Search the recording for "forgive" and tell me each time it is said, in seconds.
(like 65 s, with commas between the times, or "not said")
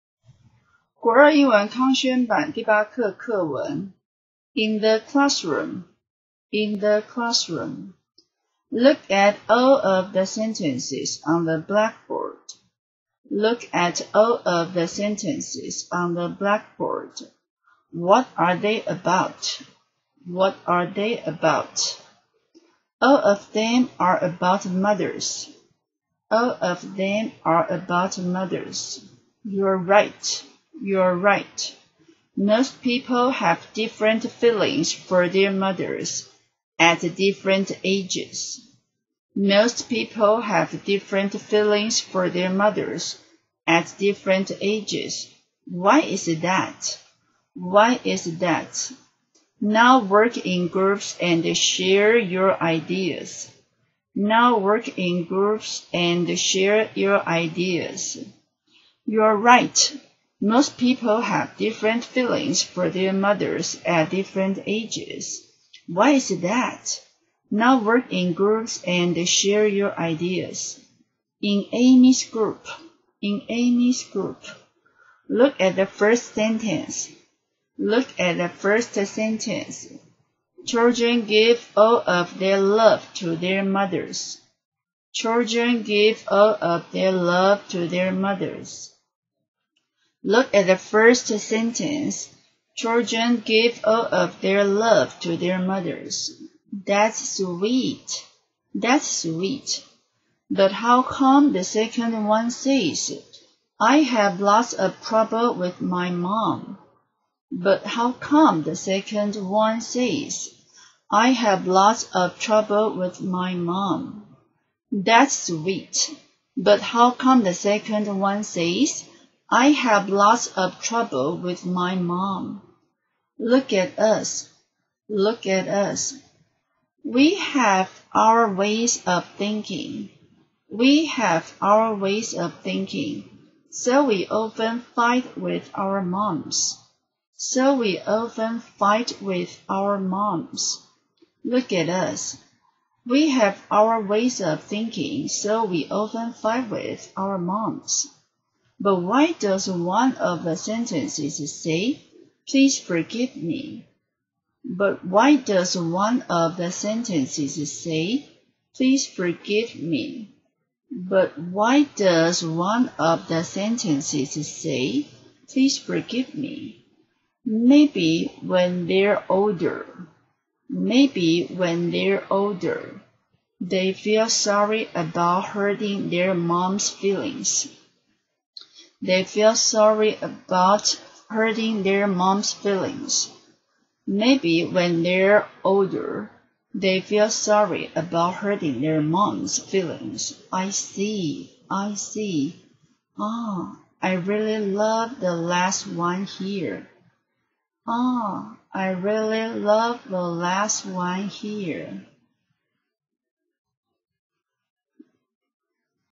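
152 s, 159 s, 165 s.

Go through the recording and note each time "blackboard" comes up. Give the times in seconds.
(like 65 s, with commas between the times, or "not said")
11 s, 16 s.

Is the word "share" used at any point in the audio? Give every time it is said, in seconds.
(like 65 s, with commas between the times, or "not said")
51 s, 56 s, 69 s.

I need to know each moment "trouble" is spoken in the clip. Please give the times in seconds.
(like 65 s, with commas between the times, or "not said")
105 s, 112 s, 120 s.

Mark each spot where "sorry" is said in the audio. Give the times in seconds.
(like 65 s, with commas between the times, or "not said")
174 s, 179 s, 187 s.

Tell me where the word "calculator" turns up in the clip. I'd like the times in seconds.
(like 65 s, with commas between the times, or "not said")
not said.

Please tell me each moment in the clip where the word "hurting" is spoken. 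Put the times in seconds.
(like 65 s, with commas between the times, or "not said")
175 s, 181 s, 188 s.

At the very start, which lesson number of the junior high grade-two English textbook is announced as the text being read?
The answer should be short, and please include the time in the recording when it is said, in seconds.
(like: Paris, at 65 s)
8, at 2 s.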